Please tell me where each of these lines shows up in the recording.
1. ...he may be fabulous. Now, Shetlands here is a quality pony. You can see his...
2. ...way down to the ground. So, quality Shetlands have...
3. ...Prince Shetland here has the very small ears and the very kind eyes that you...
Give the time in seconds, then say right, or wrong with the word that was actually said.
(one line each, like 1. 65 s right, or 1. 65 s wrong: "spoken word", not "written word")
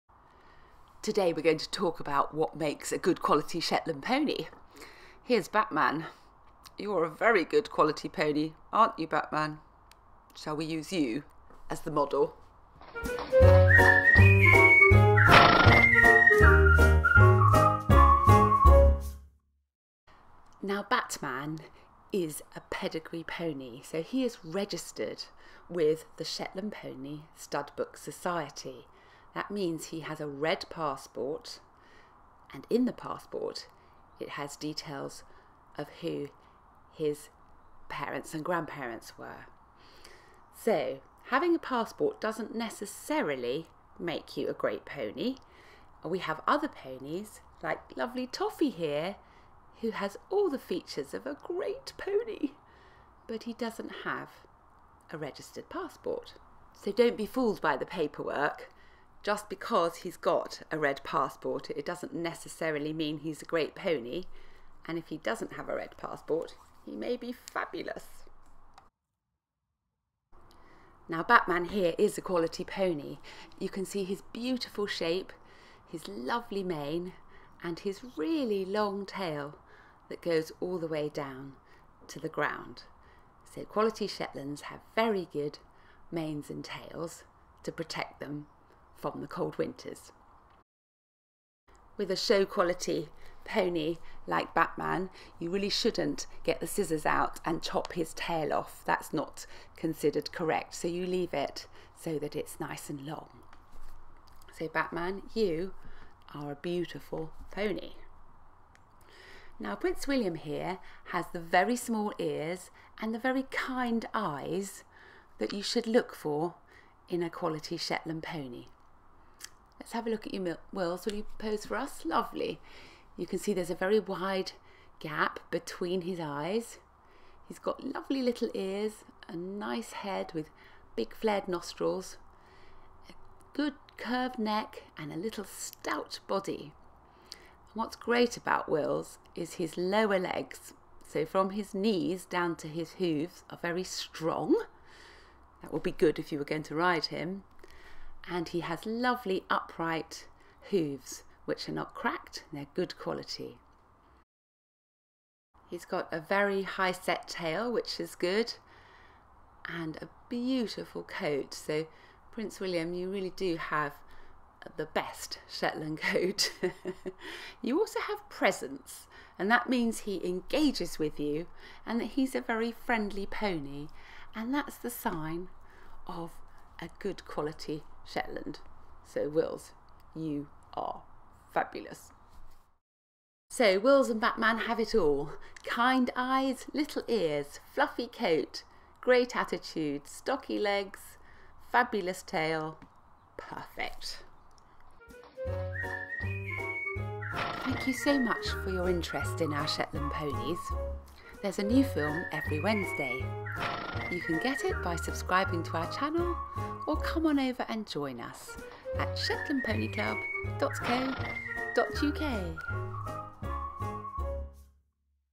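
1. 66 s wrong: "Batman", not "Shetlands"
2. 80 s right
3. 109 s wrong: "William", not "Shetland".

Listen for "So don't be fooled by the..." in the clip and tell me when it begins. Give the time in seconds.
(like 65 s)
56 s.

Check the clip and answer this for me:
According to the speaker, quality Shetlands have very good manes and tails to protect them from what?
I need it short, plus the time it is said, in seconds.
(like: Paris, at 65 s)
The cold winters, at 89 s.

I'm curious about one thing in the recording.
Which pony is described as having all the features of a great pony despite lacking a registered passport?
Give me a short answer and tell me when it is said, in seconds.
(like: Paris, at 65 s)
Toffee, at 48 s.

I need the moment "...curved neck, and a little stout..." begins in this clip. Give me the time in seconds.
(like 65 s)
133 s.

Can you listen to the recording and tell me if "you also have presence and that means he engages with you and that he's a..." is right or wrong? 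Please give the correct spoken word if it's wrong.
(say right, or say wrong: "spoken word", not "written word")
right.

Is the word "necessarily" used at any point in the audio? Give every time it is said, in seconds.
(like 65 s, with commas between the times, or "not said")
42 s, 62 s.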